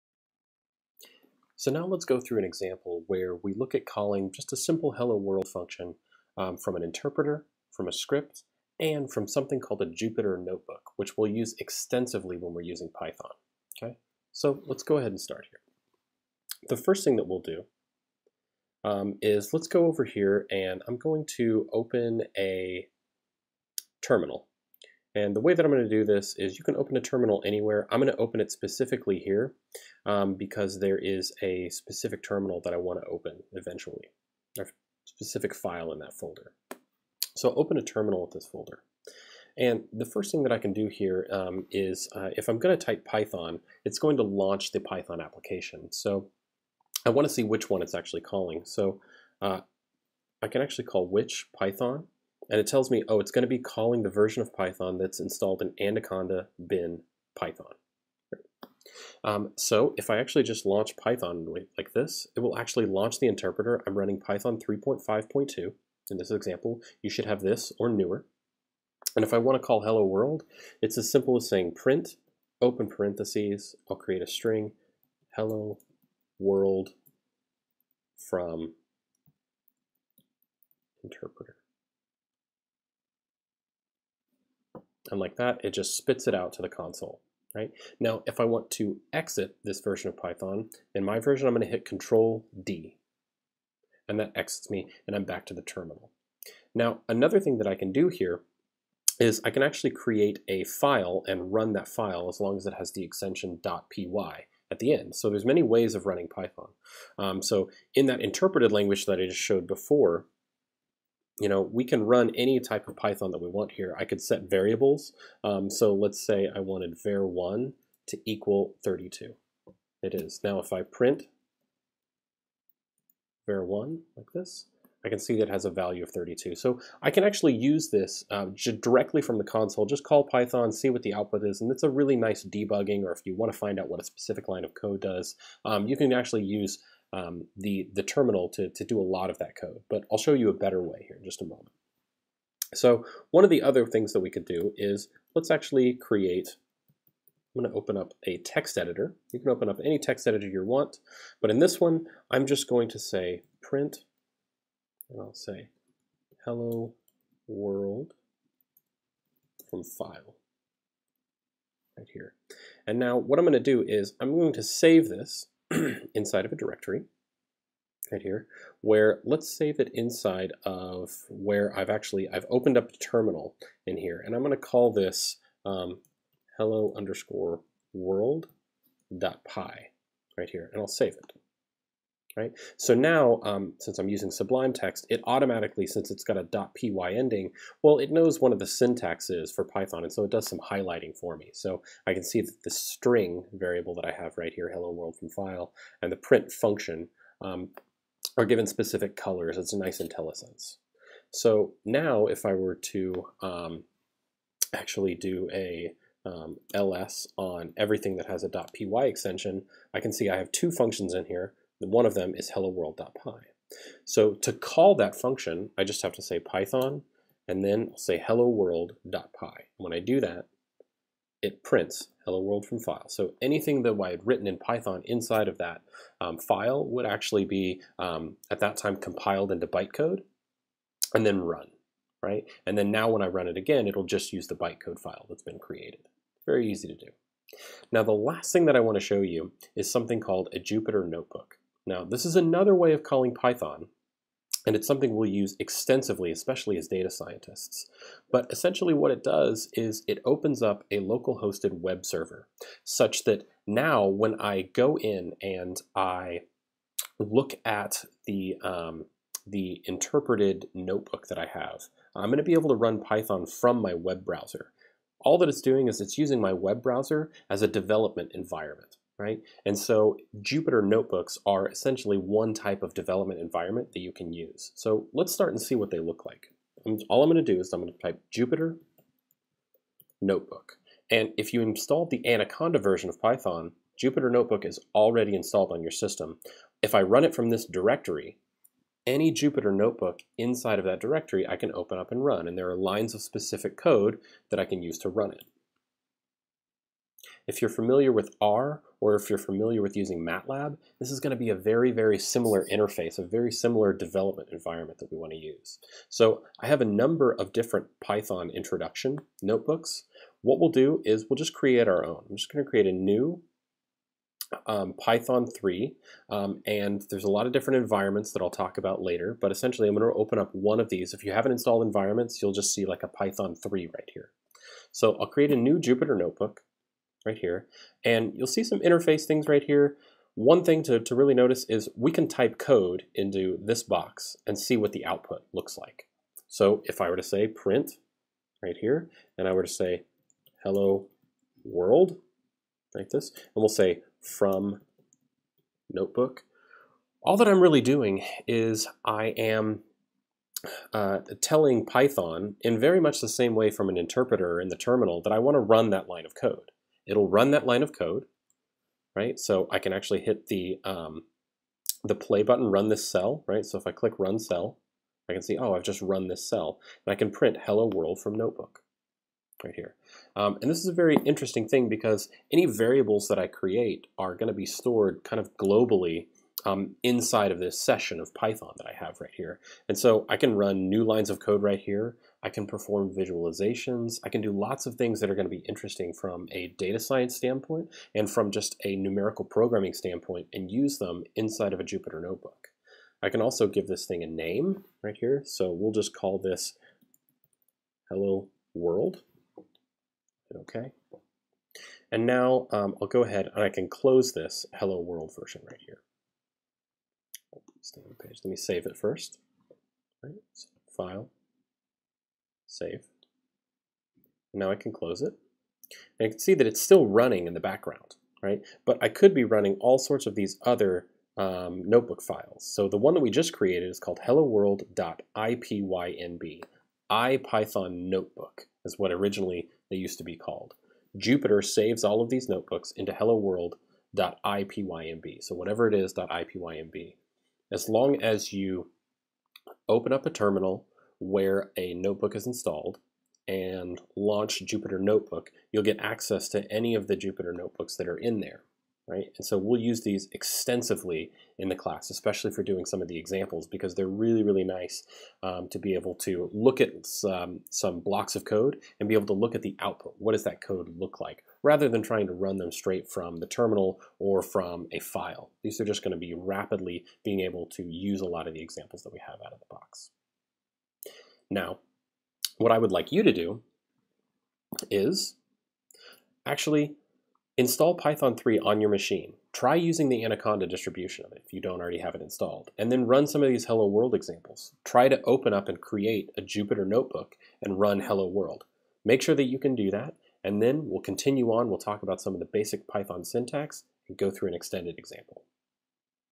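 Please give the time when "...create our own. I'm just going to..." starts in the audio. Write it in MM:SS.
05:11.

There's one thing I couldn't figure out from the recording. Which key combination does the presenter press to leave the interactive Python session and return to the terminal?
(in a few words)
Control D.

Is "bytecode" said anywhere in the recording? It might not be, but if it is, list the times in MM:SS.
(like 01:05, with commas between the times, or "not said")
03:49, 03:54.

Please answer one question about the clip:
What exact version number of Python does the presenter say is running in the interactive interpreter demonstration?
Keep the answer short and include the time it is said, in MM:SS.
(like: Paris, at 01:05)
3.5.2, at 01:04.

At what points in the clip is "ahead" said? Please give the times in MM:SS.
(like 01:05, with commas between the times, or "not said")
00:14, 06:43.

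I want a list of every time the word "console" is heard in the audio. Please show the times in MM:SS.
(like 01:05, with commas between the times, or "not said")
01:26, 02:09.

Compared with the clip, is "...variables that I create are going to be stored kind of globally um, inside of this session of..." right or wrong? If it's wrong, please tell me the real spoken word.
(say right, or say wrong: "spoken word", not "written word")
right.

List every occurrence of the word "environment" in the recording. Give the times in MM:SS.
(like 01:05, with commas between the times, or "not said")
04:28, 04:33, 05:04, 05:17, 05:21.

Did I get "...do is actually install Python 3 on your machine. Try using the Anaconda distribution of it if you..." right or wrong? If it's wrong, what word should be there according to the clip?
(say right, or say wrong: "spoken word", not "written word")
right.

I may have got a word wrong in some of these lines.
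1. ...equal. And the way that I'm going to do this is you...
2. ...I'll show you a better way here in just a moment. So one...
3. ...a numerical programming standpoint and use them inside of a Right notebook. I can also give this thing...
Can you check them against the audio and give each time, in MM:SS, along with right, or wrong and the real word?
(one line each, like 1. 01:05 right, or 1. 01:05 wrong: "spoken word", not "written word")
1. 00:24 wrong: "terminal", not "equal"
2. 02:20 right
3. 06:28 wrong: "Jupyter", not "Right".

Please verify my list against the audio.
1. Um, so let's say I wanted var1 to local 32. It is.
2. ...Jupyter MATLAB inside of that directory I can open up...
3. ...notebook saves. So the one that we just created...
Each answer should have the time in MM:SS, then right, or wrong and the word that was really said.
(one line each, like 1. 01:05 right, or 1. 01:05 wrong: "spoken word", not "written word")
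1. 01:55 wrong: "equal", not "local"
2. 04:49 wrong: "Notebook", not "MATLAB"
3. 07:01 wrong: "files", not "saves".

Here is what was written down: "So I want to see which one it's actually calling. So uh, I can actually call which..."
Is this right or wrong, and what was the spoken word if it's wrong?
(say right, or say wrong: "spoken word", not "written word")
right.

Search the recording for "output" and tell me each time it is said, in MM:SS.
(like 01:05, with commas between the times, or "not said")
02:11, 05:35, 07:39.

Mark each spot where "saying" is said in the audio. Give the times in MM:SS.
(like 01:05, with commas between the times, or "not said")
01:11.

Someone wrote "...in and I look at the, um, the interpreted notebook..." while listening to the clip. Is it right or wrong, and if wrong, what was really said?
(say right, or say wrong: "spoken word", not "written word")
right.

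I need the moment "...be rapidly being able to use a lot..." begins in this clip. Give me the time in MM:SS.
07:46.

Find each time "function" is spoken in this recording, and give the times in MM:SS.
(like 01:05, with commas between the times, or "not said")
00:05, 03:16, 03:30, 03:35.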